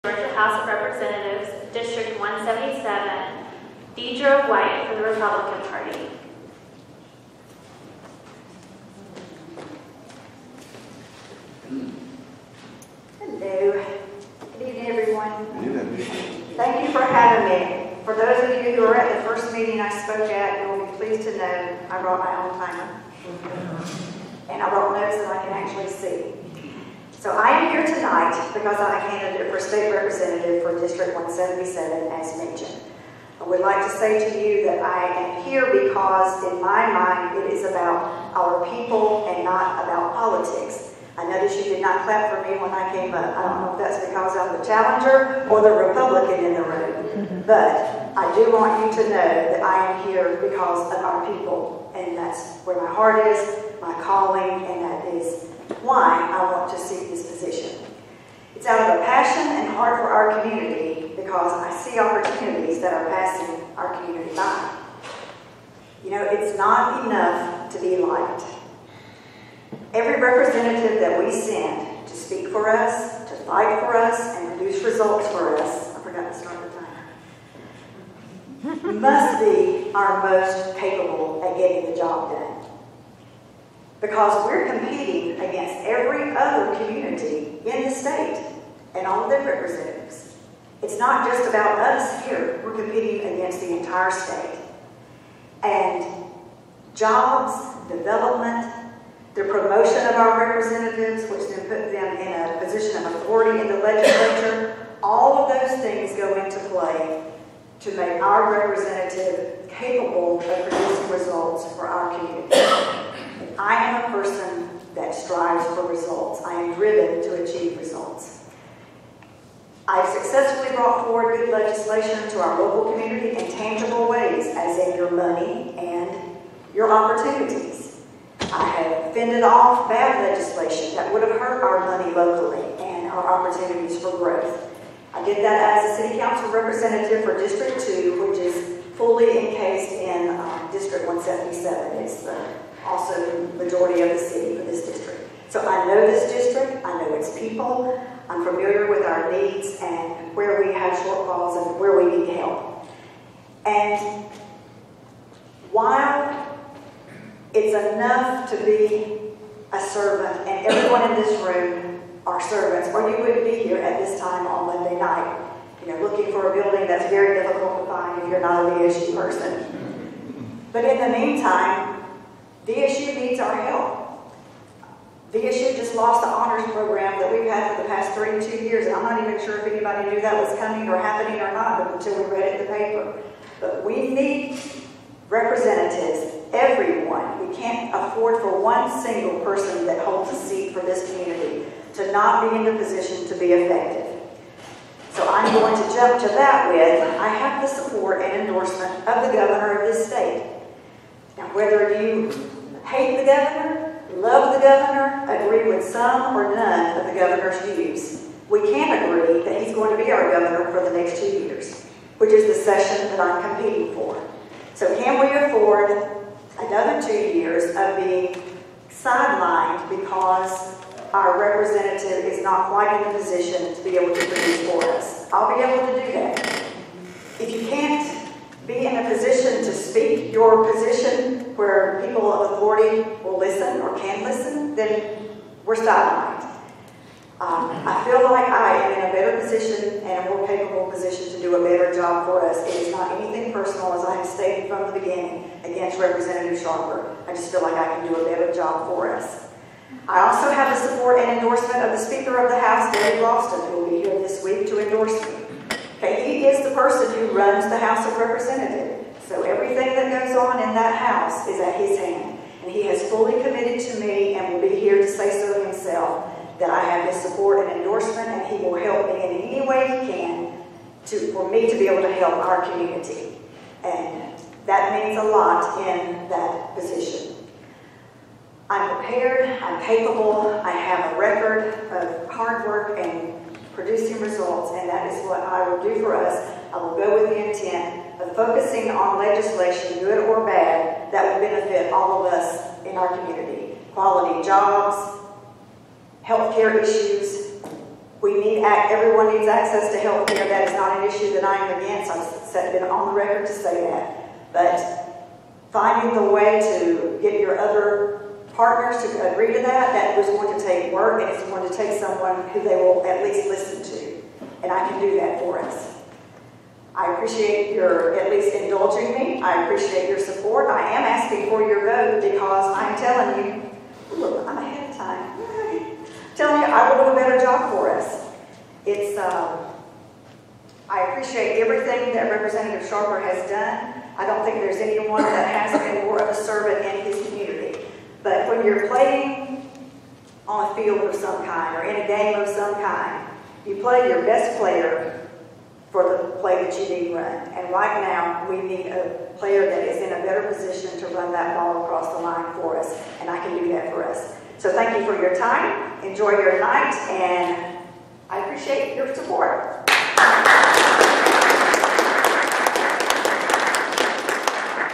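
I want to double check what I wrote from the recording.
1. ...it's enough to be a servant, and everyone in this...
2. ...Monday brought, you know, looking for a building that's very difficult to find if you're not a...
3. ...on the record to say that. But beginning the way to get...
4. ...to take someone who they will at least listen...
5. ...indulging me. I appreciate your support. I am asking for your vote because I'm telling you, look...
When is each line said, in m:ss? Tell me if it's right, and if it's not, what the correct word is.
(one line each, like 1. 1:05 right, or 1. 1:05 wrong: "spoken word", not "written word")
1. 2:37 right
2. 2:44 wrong: "night", not "brought"
3. 5:02 wrong: "finding", not "beginning"
4. 5:11 right
5. 5:18 right.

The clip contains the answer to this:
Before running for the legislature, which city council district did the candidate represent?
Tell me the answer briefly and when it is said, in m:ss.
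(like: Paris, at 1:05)
District 2, at 2:17.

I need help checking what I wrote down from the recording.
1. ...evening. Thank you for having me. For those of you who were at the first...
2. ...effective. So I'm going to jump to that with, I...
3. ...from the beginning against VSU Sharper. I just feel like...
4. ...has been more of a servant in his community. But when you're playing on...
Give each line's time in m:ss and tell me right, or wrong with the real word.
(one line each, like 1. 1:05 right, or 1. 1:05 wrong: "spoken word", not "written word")
1. 0:15 right
2. 3:13 right
3. 4:04 wrong: "Representative", not "VSU"
4. 5:35 right.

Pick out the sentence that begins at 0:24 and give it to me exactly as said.
And I brought notes that I can actually see.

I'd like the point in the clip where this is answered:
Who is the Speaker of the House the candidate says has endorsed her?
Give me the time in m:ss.
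4:12.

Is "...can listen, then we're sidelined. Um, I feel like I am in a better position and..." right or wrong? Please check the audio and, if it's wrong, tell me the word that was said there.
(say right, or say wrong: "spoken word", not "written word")
right.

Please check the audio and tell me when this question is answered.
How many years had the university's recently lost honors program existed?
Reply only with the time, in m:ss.
2:58.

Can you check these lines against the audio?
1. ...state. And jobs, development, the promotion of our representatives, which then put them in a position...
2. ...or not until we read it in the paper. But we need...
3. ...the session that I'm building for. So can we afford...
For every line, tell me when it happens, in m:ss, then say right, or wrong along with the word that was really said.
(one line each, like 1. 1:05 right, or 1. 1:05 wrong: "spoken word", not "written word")
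1. 1:34 right
2. 3:01 right
3. 3:32 wrong: "competing", not "building".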